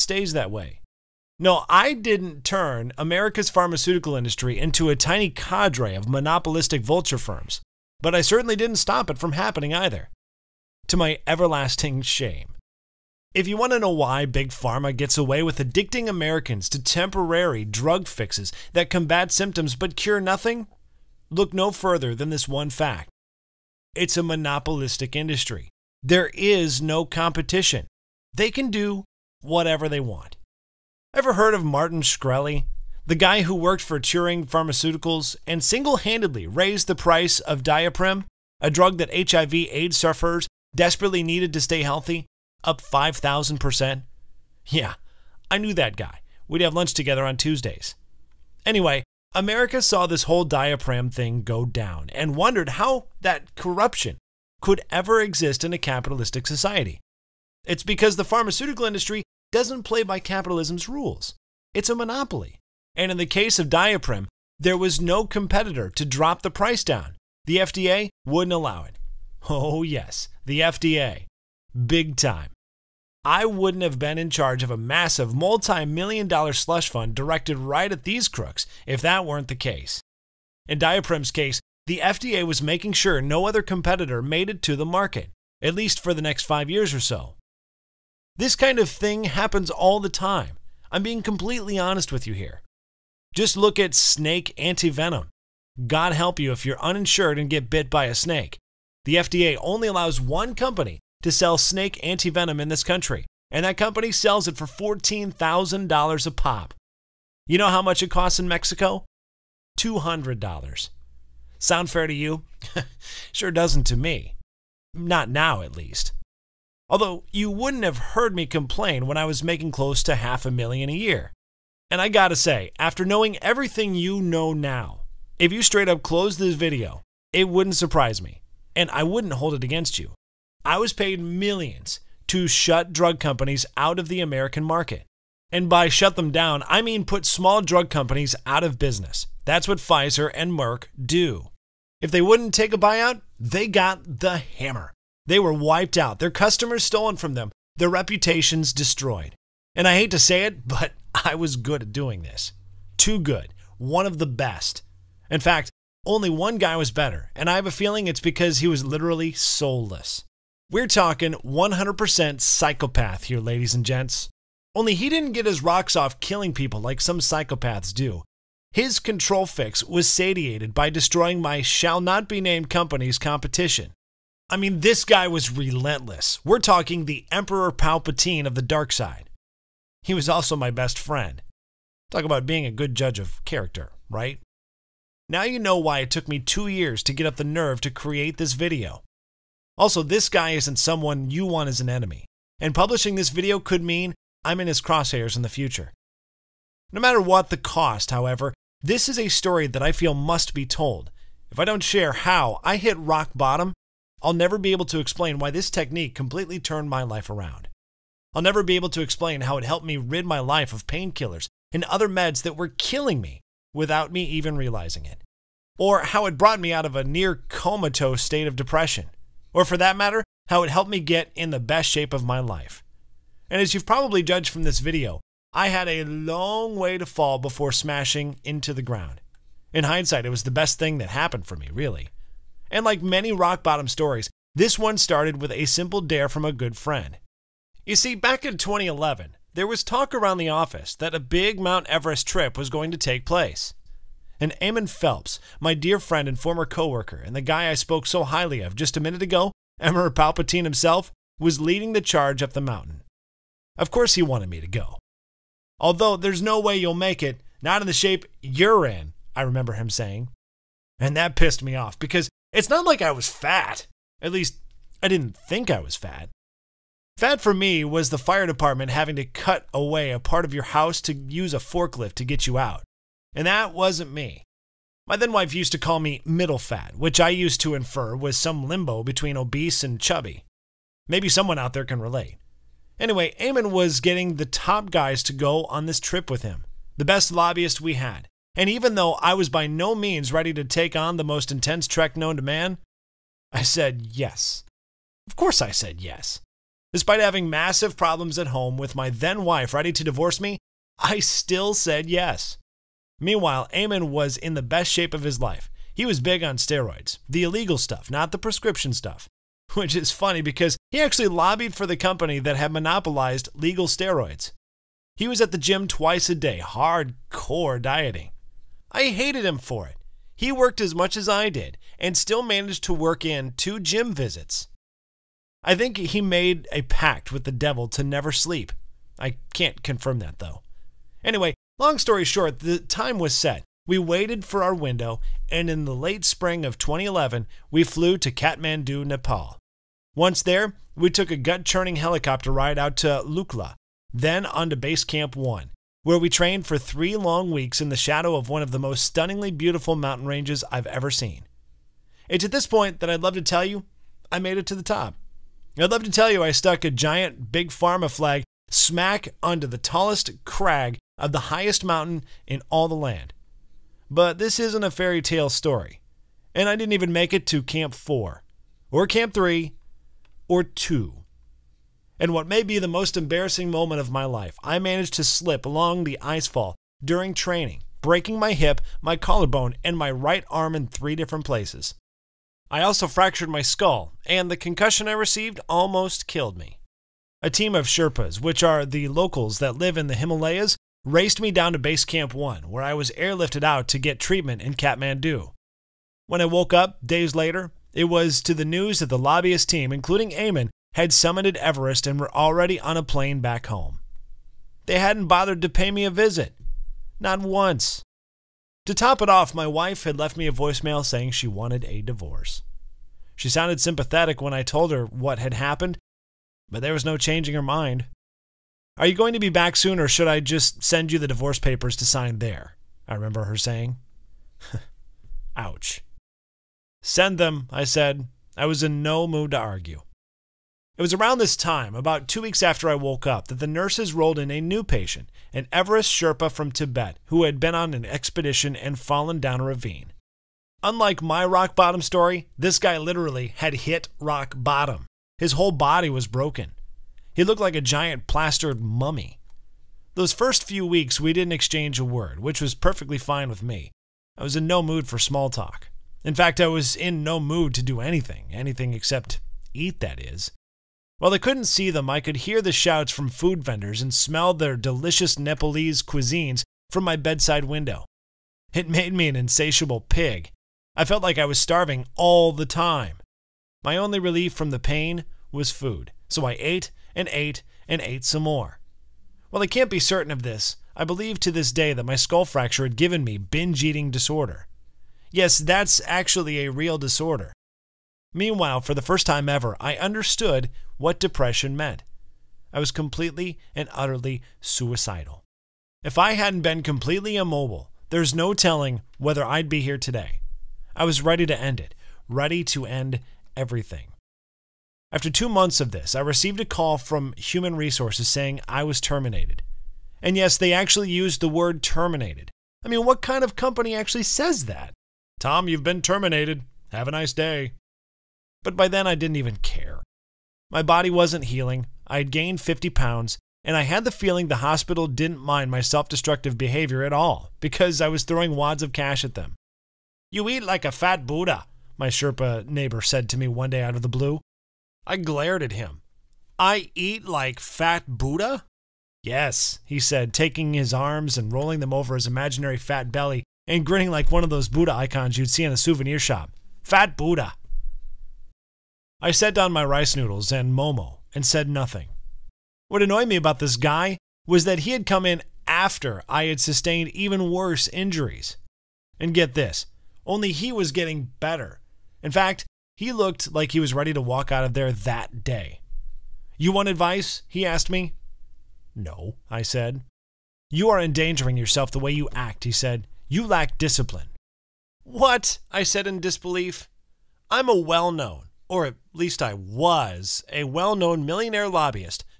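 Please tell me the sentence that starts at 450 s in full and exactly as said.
Those first few weeks, we didn't exchange a word, which was perfectly fine with me.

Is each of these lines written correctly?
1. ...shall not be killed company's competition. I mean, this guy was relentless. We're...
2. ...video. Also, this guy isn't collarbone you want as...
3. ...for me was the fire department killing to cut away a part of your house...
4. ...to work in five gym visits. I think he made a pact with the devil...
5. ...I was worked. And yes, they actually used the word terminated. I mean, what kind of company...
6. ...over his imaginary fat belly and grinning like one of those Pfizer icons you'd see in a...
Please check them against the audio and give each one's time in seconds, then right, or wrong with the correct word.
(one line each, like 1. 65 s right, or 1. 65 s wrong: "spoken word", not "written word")
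1. 171 s wrong: "named", not "killed"
2. 188 s wrong: "someone", not "collarbone"
3. 267 s wrong: "having", not "killing"
4. 322 s wrong: "two", not "five"
5. 508 s wrong: "terminated", not "worked"
6. 541 s wrong: "Buddha", not "Pfizer".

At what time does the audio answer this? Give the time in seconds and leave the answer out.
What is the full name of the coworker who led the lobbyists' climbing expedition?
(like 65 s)
244 s.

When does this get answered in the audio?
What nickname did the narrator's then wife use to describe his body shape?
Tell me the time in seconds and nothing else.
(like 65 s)
276 s.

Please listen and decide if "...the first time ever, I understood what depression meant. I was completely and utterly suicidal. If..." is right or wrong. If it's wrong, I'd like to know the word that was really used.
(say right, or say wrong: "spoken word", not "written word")
right.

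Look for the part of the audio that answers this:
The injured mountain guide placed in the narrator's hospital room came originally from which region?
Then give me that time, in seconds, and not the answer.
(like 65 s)
436 s.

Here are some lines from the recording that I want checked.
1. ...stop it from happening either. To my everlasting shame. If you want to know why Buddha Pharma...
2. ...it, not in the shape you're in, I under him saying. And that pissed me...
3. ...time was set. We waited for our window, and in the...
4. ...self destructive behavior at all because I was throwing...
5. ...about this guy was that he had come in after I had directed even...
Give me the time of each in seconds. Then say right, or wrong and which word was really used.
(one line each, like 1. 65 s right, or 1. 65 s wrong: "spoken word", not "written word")
1. 8 s wrong: "Big", not "Buddha"
2. 257 s wrong: "remember", not "under"
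3. 332 s right
4. 525 s right
5. 553 s wrong: "sustained", not "directed".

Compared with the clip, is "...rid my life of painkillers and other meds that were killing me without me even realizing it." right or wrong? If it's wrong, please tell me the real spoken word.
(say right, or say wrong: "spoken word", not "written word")
right.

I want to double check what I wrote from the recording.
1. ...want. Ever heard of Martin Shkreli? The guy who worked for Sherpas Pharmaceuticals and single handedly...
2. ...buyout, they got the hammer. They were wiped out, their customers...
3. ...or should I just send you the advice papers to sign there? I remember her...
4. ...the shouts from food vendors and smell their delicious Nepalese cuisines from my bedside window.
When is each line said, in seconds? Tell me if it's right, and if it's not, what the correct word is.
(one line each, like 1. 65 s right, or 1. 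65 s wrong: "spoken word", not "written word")
1. 30 s wrong: "Turing", not "Sherpas"
2. 142 s right
3. 419 s wrong: "divorce", not "advice"
4. 462 s right.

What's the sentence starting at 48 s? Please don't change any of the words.
Anyway, America saw this whole Daraprim thing go down and wondered how that corruption could ever exist in a capitalistic society.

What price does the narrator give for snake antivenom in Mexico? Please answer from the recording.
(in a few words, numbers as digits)
$200.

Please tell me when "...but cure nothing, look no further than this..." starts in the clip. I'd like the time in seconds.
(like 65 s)
19 s.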